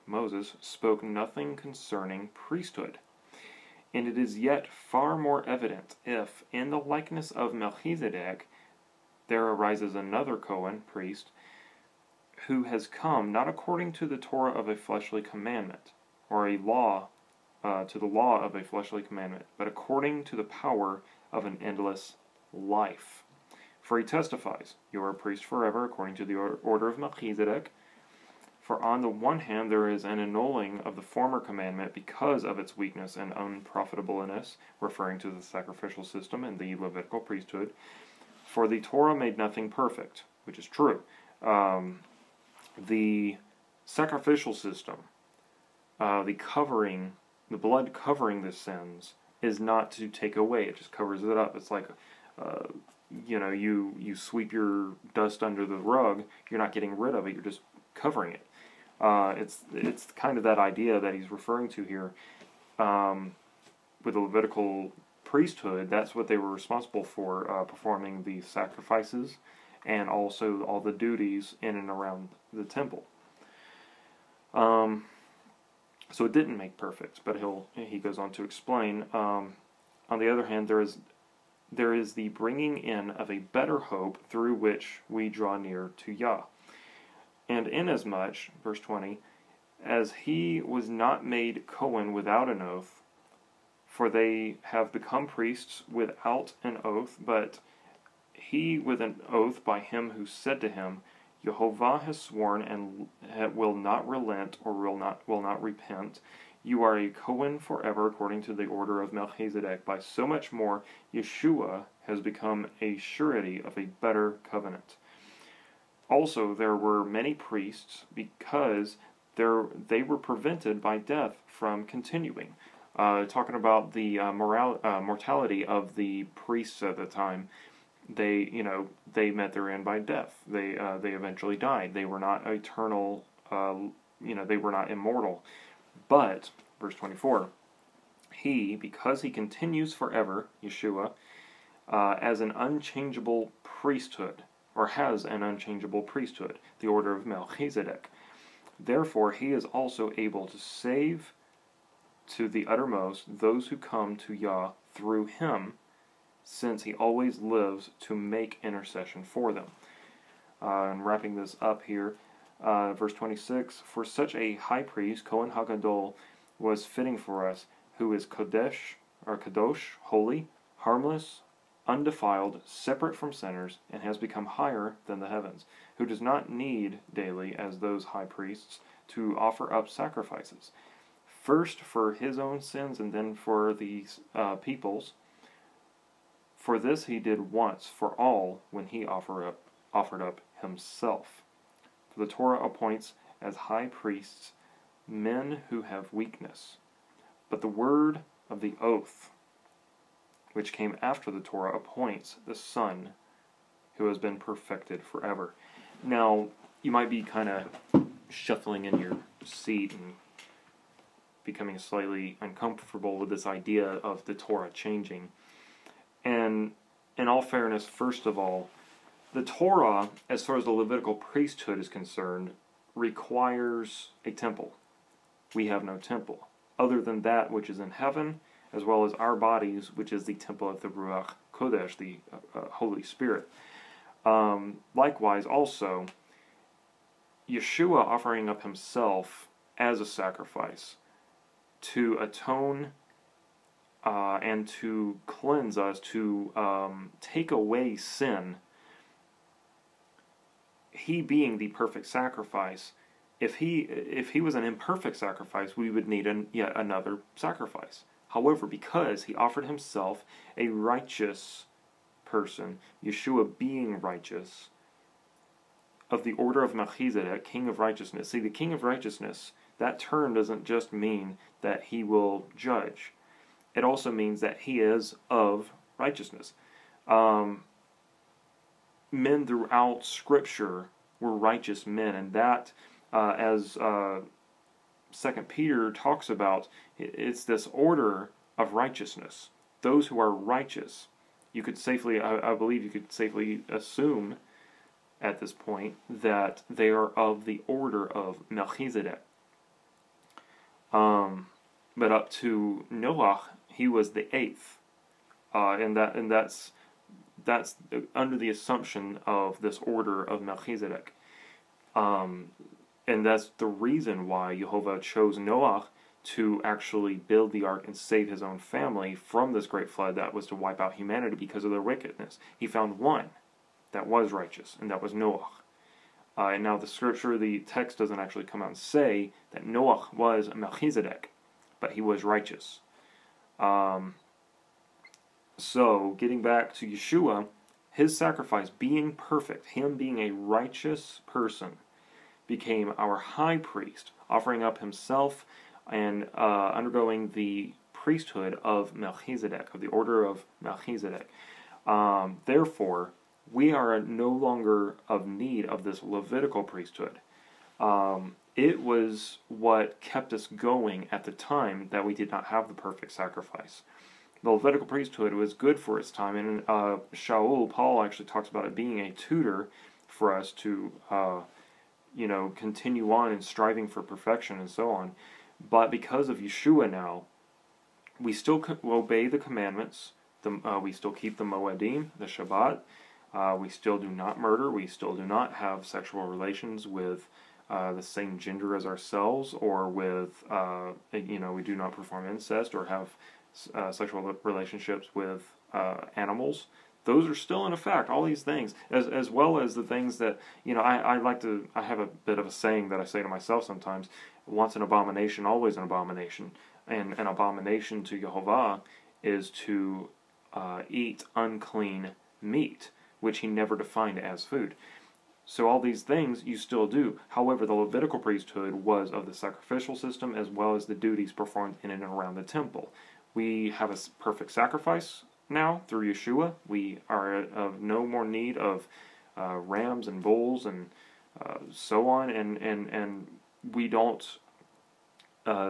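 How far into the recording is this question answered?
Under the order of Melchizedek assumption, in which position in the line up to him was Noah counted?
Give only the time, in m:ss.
5:04.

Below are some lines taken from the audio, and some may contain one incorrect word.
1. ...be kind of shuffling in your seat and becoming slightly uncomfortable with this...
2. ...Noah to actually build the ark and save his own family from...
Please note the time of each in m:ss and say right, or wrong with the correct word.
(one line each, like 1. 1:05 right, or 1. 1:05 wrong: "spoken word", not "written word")
1. 3:27 right
2. 5:15 right.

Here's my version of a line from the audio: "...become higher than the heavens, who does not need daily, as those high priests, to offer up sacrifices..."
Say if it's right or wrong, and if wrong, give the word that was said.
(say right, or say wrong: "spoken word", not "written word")
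right.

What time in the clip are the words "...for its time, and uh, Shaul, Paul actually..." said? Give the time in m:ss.
6:05.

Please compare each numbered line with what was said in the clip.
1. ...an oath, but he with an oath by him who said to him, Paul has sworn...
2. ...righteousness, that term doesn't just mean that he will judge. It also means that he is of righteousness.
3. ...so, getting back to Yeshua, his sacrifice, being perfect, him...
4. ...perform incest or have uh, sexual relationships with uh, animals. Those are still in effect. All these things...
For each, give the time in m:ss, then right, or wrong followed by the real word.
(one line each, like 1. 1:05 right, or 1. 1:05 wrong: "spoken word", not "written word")
1. 1:36 wrong: "Jehovah", not "Paul"
2. 4:28 right
3. 5:35 right
4. 6:31 right.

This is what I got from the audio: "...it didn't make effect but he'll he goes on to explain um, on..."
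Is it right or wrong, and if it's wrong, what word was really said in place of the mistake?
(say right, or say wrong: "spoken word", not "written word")
wrong: "perfect", not "effect".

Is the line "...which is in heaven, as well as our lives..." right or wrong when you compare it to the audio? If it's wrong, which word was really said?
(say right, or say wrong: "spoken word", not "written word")
wrong: "bodies", not "lives".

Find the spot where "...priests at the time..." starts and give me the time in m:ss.
2:06.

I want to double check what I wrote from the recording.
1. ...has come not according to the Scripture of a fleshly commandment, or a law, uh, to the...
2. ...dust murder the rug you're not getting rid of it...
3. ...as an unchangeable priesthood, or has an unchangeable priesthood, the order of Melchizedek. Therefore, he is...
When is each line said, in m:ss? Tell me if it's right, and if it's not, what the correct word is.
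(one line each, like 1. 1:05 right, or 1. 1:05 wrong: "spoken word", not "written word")
1. 0:12 wrong: "Torah", not "Scripture"
2. 0:55 wrong: "under", not "murder"
3. 2:22 right.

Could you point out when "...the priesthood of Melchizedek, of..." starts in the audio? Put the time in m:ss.
5:47.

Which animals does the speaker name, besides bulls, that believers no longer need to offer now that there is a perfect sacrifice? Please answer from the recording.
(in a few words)
Rams.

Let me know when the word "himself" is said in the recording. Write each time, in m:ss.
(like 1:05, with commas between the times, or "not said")
3:10, 3:58, 4:19, 5:44.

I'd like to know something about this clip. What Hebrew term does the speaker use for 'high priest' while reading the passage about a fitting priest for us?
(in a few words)
Cohen Hagadol.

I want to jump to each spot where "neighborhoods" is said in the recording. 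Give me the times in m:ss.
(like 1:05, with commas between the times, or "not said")
not said.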